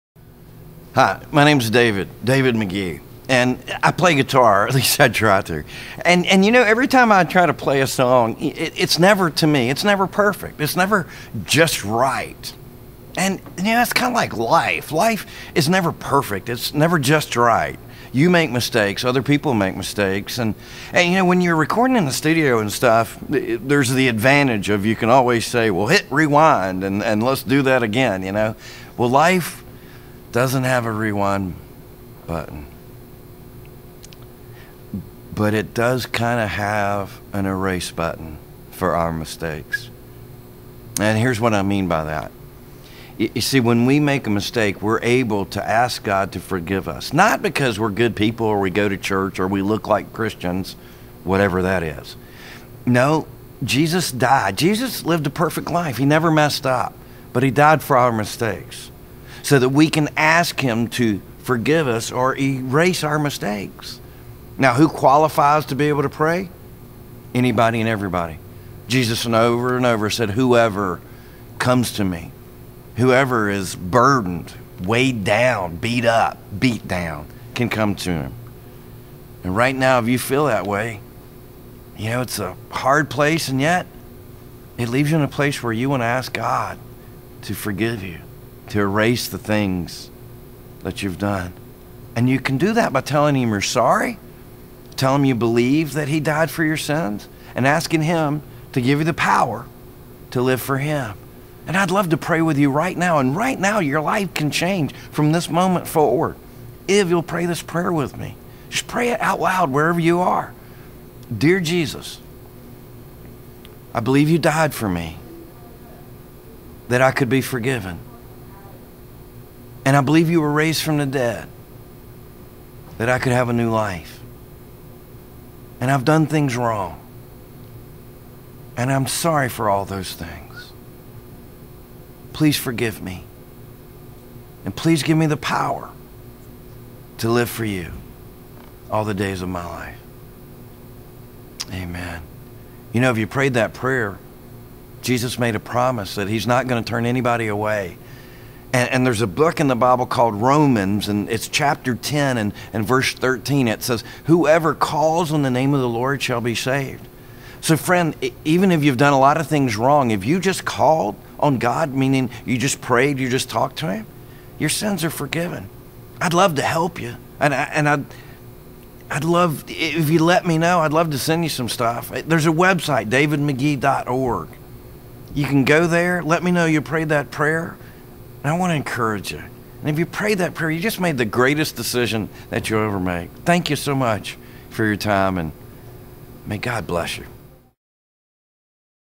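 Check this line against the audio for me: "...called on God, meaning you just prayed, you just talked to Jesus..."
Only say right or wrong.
wrong.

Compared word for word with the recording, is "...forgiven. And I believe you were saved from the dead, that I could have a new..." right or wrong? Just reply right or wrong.
wrong.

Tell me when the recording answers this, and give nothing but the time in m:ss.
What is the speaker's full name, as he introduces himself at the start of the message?
0:02.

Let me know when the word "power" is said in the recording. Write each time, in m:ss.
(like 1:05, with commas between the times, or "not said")
1:39, 2:15.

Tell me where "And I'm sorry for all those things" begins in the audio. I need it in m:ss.
2:08.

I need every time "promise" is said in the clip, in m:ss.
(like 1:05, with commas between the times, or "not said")
2:25.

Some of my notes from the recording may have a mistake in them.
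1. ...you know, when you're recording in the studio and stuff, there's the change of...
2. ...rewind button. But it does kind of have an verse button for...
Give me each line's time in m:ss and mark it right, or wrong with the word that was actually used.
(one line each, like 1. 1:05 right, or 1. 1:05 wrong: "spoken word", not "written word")
1. 0:21 wrong: "advantage", not "change"
2. 0:30 wrong: "erase", not "verse".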